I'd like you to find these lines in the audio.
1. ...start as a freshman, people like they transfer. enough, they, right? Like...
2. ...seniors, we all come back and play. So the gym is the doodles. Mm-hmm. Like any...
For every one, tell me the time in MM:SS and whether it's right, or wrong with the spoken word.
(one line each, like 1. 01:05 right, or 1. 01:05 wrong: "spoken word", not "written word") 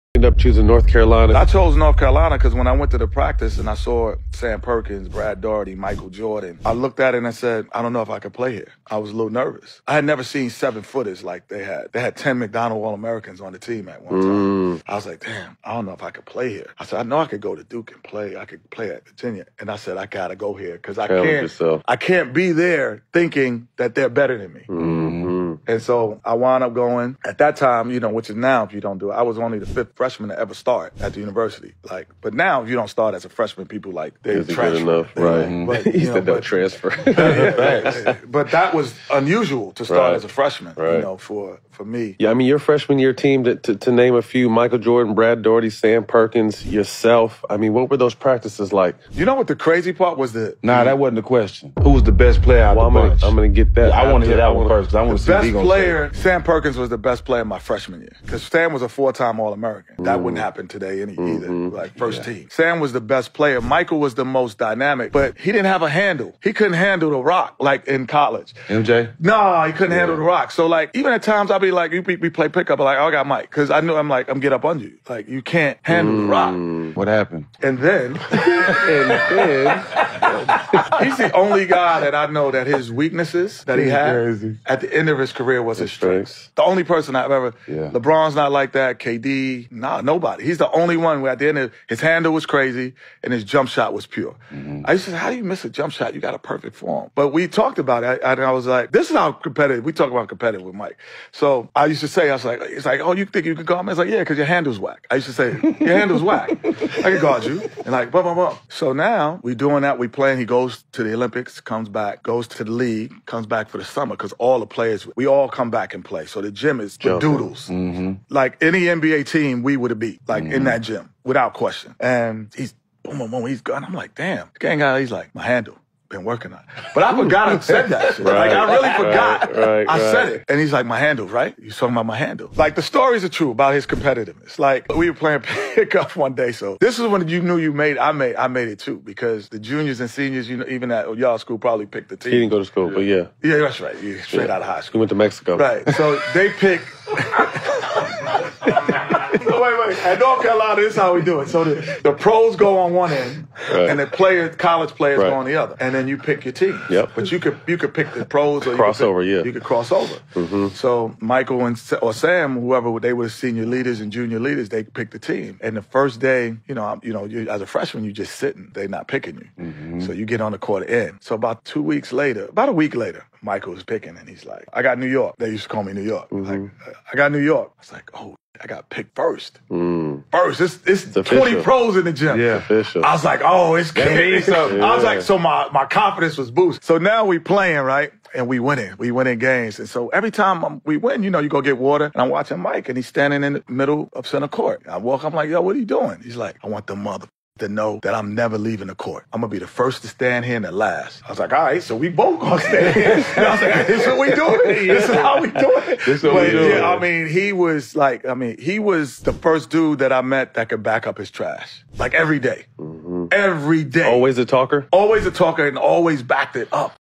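1. 00:32 right
2. 01:54 wrong: "players", not "seniors".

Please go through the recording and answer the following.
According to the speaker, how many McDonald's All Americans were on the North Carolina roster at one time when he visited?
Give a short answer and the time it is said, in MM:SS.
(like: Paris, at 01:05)
10, at 00:12.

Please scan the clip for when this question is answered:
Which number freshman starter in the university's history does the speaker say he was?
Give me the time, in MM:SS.
00:29.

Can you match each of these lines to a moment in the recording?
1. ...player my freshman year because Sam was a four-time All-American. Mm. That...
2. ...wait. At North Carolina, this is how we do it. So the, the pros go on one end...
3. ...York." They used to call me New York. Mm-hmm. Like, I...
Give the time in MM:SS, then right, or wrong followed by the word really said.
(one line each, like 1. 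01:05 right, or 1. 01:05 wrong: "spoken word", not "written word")
1. 00:57 right
2. 02:29 right
3. 02:55 right.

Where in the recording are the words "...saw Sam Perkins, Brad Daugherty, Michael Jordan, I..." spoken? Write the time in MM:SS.
00:03.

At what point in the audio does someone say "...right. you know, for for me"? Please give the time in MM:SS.
00:40.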